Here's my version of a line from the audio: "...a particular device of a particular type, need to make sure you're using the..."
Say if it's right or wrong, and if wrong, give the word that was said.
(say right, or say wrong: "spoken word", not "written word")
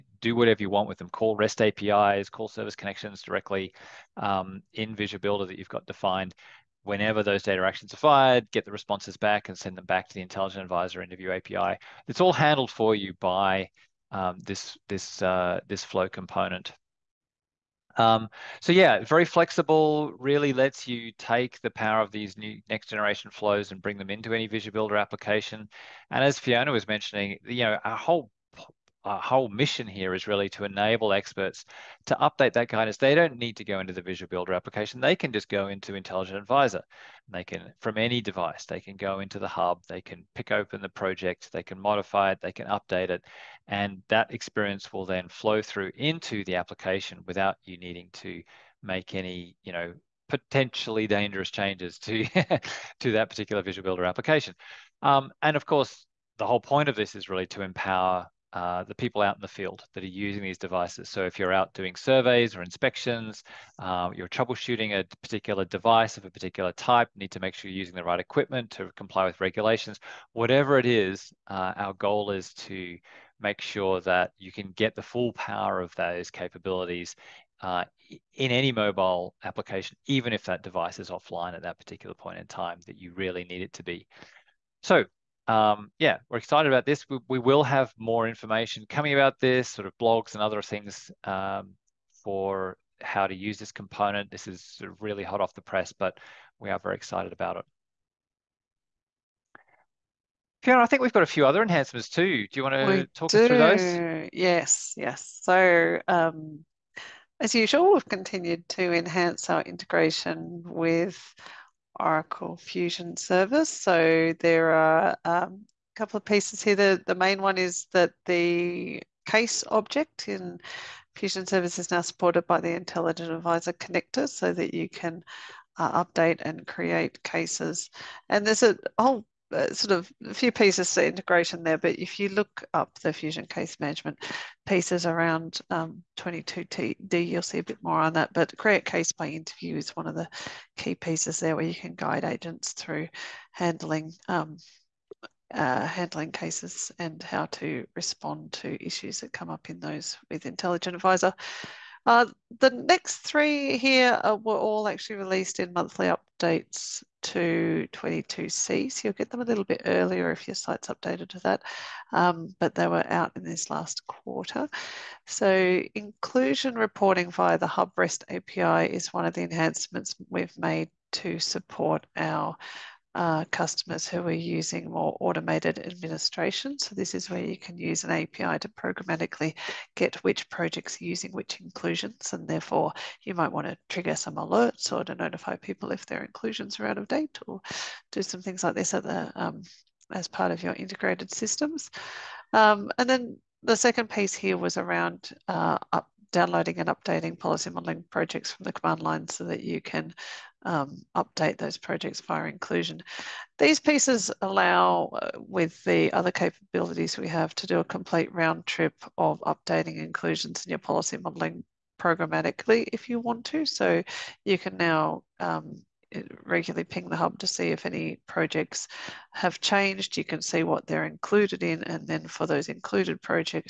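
right.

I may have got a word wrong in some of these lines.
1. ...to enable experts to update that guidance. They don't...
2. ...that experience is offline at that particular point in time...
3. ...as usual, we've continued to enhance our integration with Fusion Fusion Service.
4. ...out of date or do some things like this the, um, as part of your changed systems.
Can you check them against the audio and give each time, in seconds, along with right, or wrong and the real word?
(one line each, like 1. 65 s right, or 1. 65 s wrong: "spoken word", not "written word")
1. 30 s right
2. 80 s wrong: "device", not "experience"
3. 107 s wrong: "Oracle", not "Fusion"
4. 186 s wrong: "integrated", not "changed".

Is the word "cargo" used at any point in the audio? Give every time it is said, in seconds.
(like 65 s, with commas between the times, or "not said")
not said.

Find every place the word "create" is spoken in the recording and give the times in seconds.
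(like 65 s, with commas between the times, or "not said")
126 s, 138 s.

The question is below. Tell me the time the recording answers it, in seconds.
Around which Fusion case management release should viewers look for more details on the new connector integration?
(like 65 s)
136 s.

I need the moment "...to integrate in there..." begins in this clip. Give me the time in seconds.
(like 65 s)
130 s.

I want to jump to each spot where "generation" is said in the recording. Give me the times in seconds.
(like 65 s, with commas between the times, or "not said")
22 s.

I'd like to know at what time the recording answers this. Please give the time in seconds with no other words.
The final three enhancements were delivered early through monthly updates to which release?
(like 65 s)
157 s.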